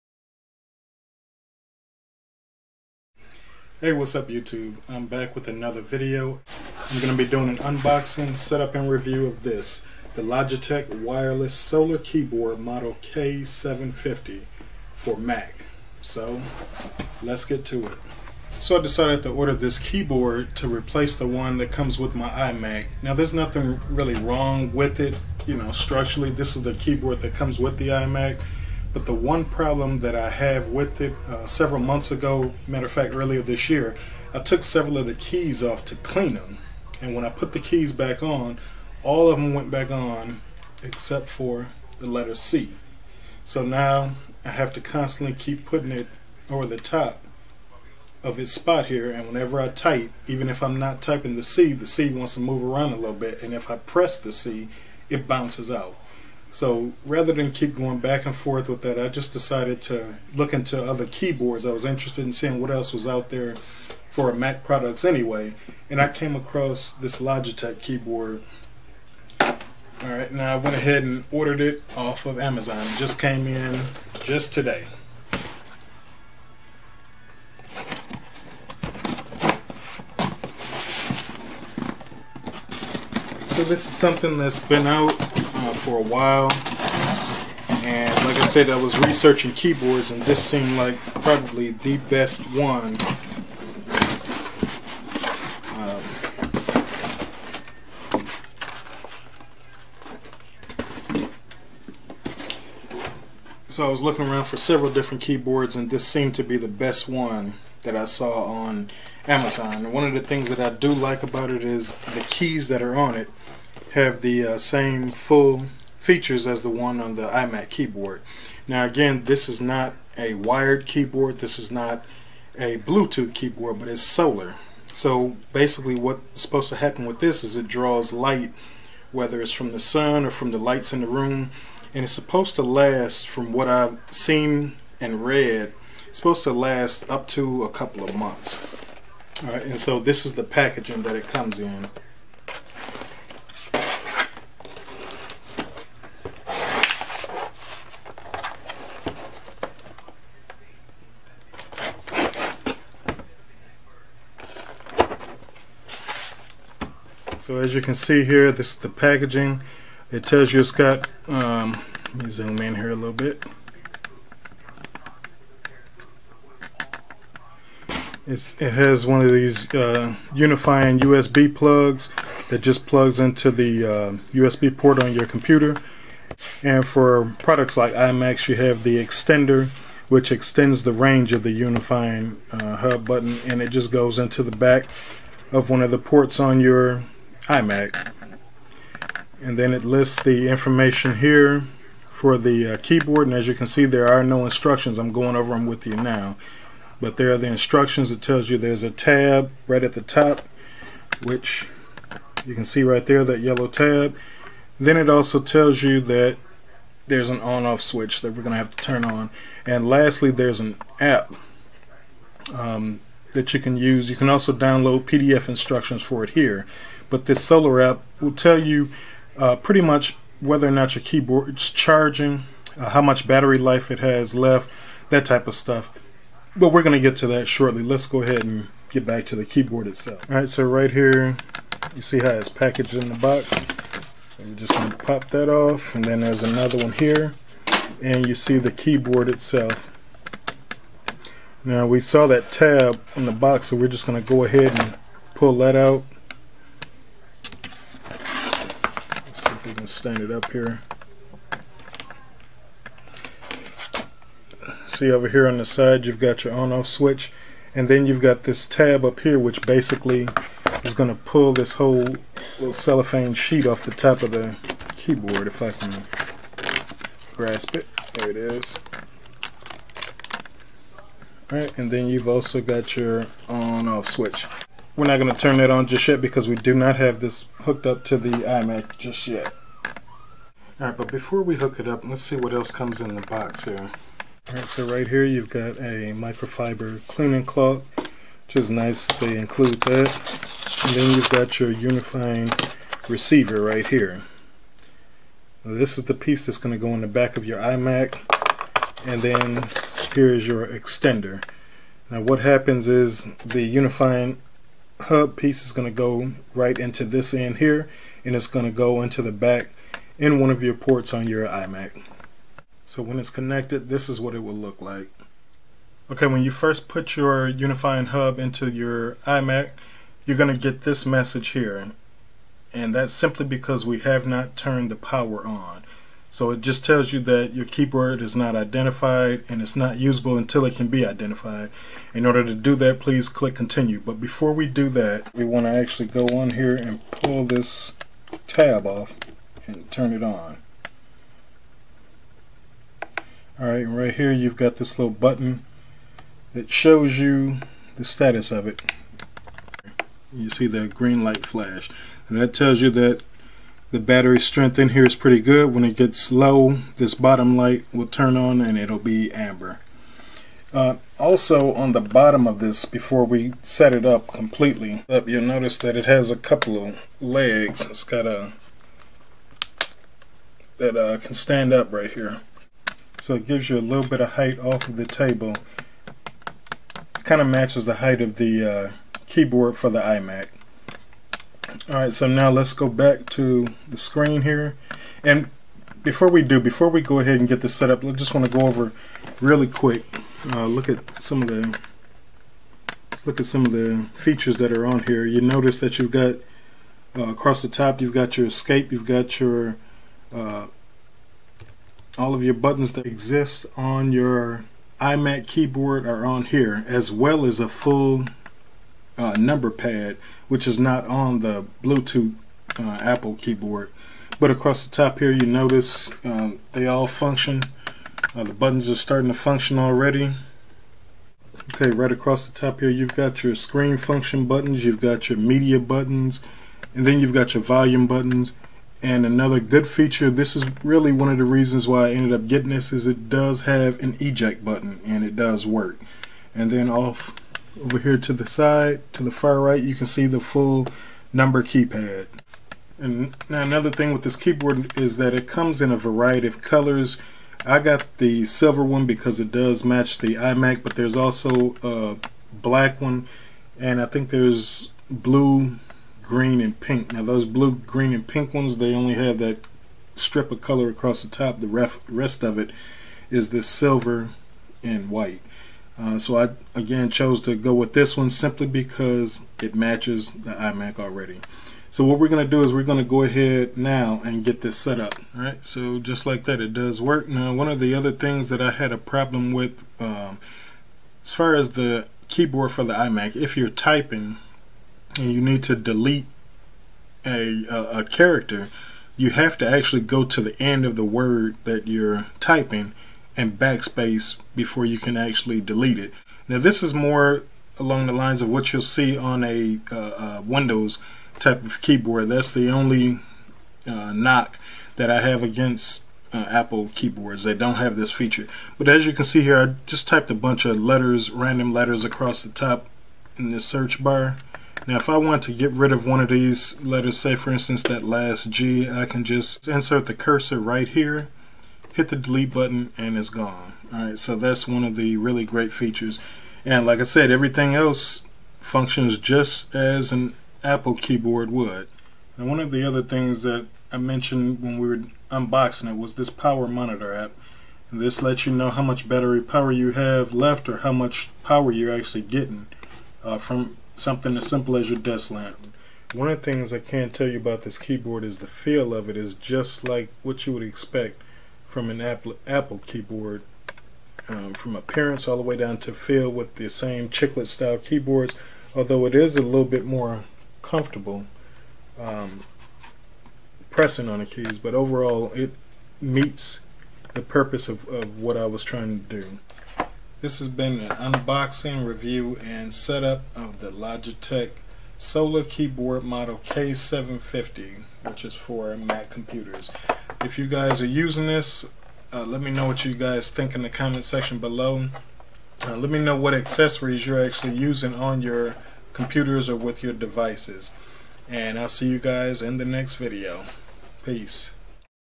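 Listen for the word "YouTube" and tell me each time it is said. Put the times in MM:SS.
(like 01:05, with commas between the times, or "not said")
00:04.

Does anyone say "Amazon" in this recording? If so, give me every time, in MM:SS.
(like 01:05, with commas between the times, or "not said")
01:12, 01:49.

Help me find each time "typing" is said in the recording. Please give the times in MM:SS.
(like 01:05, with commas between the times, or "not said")
00:51, 08:03, 08:12.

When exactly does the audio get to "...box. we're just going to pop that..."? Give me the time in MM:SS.
03:53.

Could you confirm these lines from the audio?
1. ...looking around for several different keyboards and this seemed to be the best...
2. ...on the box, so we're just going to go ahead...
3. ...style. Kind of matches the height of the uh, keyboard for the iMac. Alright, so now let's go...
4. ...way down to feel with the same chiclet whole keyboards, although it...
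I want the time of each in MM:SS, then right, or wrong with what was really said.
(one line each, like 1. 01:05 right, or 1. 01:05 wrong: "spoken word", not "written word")
1. 01:44 right
2. 04:03 right
3. 06:15 wrong: "table", not "style"
4. 09:15 wrong: "style", not "whole".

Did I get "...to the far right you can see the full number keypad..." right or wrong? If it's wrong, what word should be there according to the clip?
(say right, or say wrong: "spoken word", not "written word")
right.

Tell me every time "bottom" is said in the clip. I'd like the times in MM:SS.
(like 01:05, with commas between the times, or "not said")
05:57, 06:01.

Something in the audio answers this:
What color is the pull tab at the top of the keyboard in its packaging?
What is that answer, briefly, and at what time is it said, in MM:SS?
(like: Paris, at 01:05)
yellow, at 03:23.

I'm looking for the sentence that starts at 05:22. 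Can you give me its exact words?
And that's simply because we have not turned the power on.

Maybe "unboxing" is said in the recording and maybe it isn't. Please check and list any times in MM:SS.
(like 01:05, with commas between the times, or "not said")
00:07, 08:55, 09:30.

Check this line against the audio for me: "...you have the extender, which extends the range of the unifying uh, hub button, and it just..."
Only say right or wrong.
right.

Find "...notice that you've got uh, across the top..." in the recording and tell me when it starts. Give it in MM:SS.
06:35.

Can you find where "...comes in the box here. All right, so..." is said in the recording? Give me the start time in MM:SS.
04:42.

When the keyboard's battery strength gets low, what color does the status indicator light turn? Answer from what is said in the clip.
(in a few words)
amber.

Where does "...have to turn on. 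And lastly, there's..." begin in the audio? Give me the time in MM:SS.
03:28.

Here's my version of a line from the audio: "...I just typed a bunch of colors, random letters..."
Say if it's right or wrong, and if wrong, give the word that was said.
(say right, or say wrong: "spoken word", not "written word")
wrong: "letters", not "colors".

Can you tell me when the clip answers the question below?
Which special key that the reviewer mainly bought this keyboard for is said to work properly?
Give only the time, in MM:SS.
07:14.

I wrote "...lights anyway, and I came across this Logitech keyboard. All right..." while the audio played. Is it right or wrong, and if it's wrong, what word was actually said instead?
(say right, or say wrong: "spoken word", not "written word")
wrong: "products", not "lights".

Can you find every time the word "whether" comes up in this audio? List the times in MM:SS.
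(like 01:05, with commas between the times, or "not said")
02:09, 03:40.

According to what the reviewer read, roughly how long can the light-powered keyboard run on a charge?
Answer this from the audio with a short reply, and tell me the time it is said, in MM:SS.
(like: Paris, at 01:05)
a couple of months, at 02:17.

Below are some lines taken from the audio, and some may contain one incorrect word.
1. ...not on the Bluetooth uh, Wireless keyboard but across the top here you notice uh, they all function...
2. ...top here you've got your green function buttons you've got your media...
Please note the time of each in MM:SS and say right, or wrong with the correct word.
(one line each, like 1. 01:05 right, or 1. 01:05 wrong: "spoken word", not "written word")
1. 06:50 wrong: "Apple", not "Wireless"
2. 07:02 wrong: "screen", not "green".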